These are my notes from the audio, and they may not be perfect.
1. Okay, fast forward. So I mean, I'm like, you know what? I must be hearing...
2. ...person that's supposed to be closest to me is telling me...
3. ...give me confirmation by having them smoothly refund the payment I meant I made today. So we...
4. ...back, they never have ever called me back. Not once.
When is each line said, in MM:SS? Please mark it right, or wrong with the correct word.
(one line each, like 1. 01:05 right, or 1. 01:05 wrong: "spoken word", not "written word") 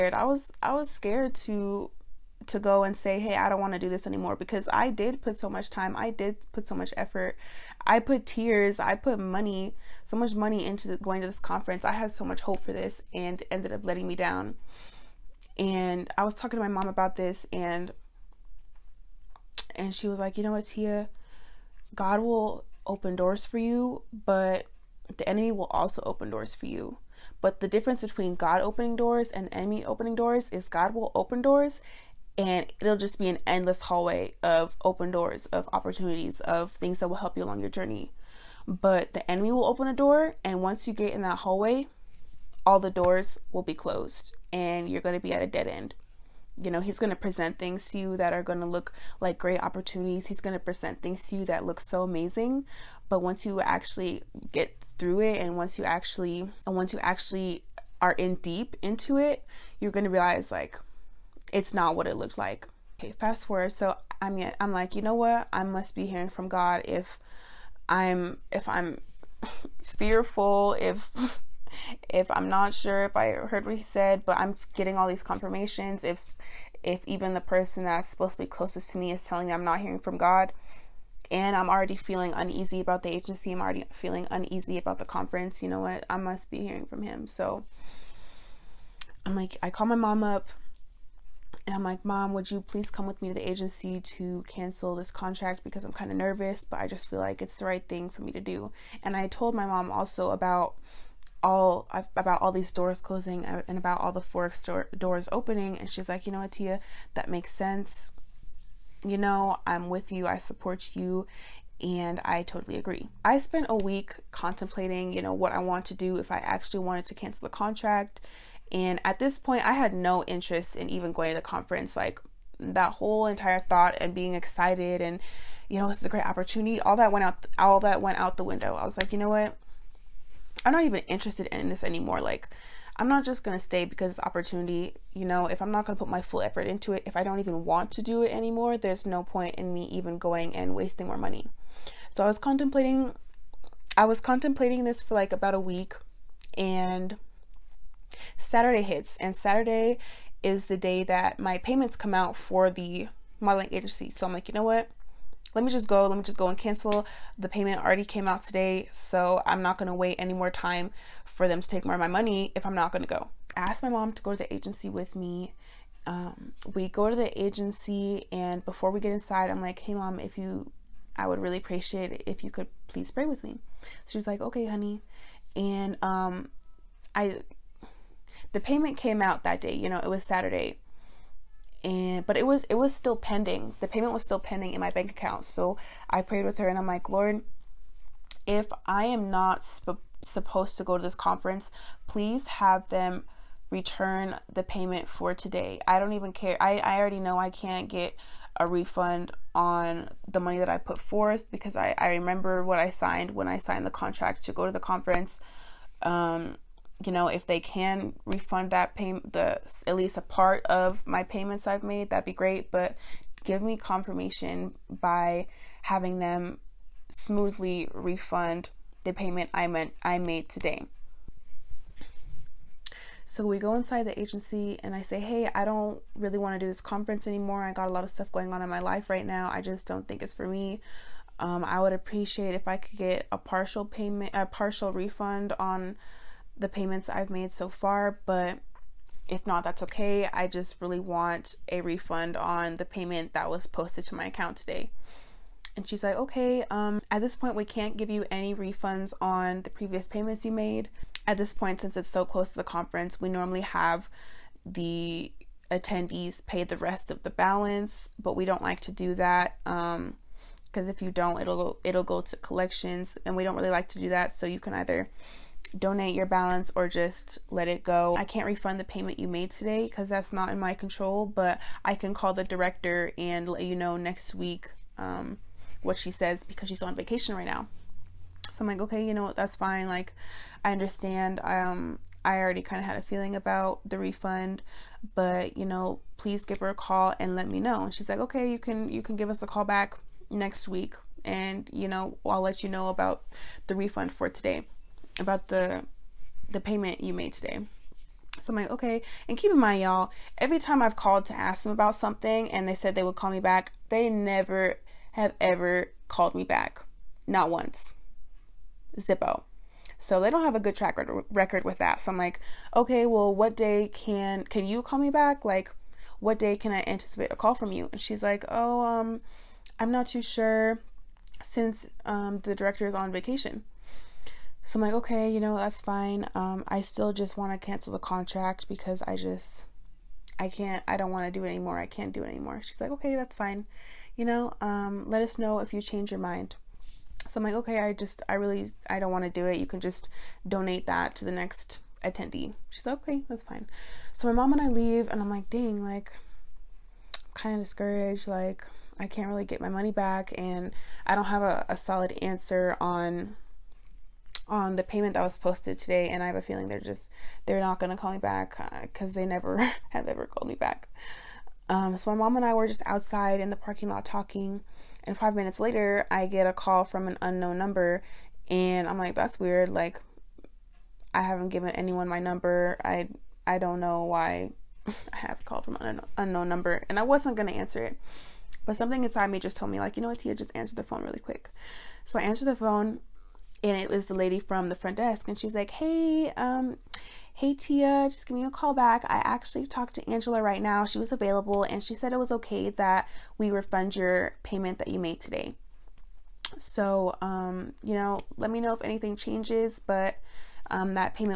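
1. 01:02 right
2. 01:17 right
3. 03:33 right
4. 05:03 right.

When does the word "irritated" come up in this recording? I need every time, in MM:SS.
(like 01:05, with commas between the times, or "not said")
not said.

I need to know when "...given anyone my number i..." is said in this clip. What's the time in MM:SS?
06:11.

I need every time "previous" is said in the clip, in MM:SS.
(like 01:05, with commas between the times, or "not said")
04:09.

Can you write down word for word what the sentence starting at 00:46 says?
You know, he's going to present things to you that are going to look like great opportunities.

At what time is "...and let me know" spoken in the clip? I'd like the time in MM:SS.
04:47.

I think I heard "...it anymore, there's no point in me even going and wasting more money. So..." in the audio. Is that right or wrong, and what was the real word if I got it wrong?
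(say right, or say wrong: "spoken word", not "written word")
right.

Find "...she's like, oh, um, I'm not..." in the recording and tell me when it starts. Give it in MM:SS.
05:18.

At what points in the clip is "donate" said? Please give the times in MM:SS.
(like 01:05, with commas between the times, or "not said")
04:25, 05:40.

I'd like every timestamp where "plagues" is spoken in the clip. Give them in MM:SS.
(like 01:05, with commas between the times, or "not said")
not said.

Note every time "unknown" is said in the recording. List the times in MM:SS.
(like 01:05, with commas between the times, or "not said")
06:07, 06:16.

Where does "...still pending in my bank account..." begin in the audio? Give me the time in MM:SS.
03:04.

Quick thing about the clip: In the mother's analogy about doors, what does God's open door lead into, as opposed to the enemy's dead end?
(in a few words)
Endless hallway.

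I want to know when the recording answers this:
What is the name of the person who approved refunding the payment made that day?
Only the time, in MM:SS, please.
06:30.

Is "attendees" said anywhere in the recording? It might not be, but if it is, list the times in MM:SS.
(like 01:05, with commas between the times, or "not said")
04:15, 05:42.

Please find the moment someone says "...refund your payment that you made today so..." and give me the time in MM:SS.
06:33.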